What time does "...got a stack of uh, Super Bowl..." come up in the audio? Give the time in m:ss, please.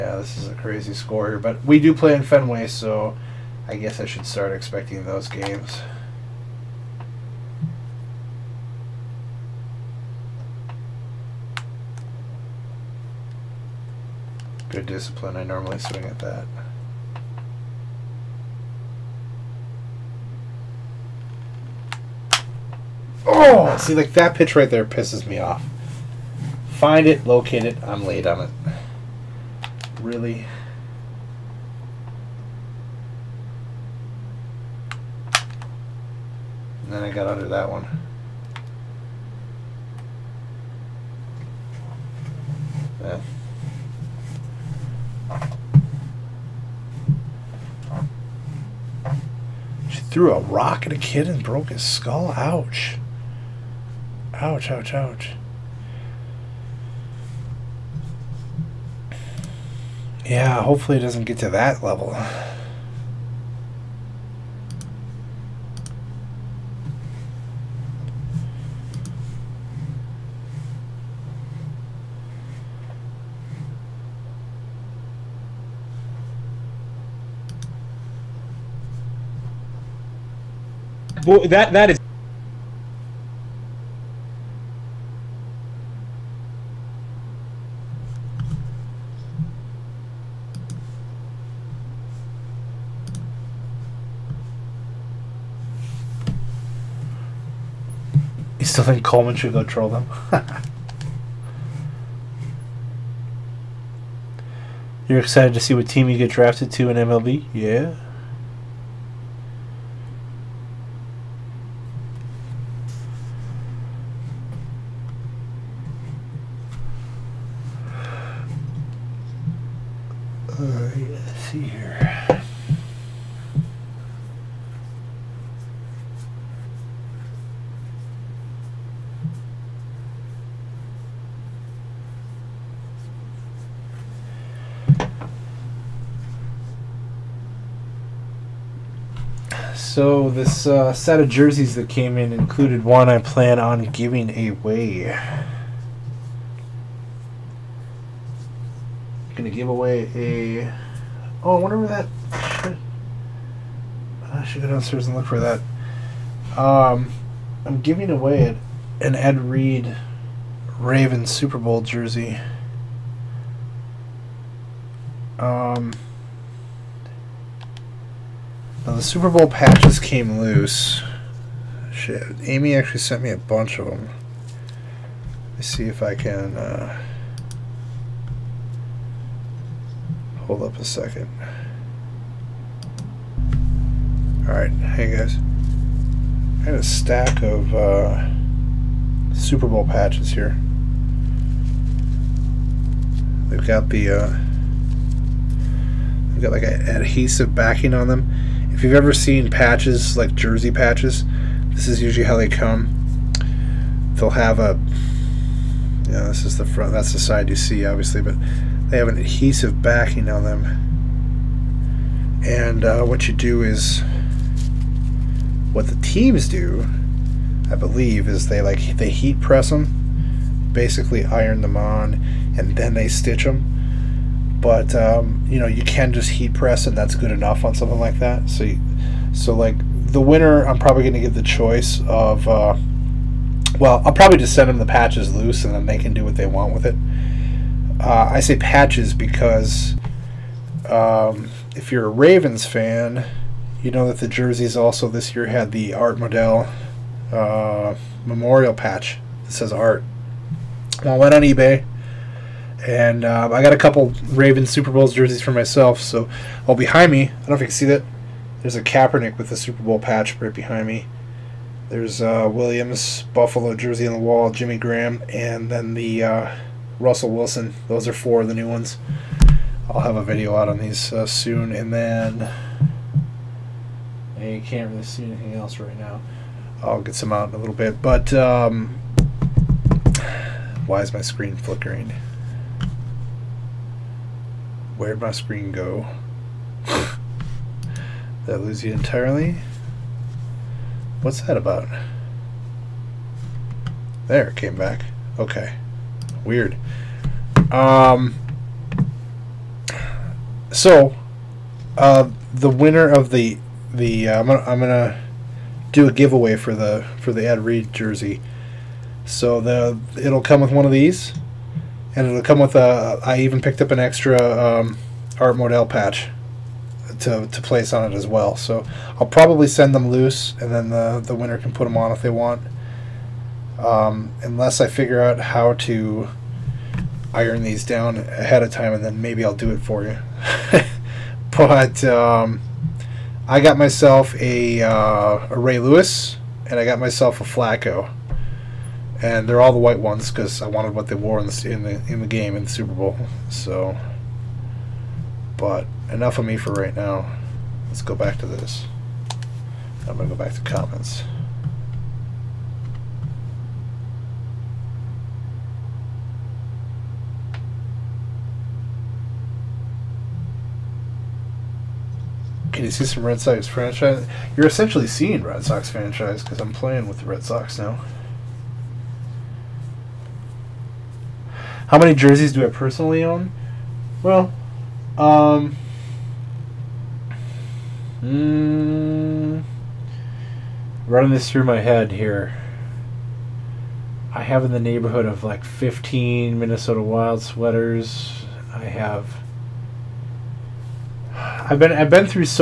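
3:06.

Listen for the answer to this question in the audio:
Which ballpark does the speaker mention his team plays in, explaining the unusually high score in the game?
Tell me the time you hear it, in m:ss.
0:02.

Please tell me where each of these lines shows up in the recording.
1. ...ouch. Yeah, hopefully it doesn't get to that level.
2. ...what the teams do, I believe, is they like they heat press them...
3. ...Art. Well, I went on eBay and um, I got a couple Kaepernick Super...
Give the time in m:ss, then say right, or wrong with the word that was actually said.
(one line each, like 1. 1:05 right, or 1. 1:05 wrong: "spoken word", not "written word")
1. 0:54 right
2. 3:35 right
3. 4:09 wrong: "Ravens", not "Kaepernick".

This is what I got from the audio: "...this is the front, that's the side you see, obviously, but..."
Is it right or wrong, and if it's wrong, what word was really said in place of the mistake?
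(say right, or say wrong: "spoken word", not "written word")
right.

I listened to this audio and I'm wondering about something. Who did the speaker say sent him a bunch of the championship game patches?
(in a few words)
Amy.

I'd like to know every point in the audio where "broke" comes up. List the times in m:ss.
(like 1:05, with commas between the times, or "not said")
0:51.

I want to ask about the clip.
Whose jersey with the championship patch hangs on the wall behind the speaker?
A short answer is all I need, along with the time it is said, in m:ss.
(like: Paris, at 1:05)
Kaepernick, at 4:18.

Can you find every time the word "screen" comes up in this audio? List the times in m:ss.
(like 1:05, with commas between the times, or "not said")
4:41, 4:45.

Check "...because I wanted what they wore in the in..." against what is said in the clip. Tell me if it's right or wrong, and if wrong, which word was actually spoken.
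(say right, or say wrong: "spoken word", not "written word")
right.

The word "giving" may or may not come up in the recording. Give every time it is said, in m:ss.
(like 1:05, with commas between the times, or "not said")
2:23, 2:37.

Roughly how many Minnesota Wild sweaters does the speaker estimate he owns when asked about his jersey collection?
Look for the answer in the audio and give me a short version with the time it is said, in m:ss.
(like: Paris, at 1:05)
15, at 6:25.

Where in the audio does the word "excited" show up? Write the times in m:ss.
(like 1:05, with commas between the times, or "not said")
1:45.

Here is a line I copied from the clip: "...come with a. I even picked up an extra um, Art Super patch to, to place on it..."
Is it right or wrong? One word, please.
wrong.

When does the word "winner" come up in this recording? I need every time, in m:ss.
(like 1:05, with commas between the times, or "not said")
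3:50, 5:02, 5:21.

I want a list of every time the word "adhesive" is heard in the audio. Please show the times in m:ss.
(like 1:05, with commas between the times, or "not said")
3:16, 3:29.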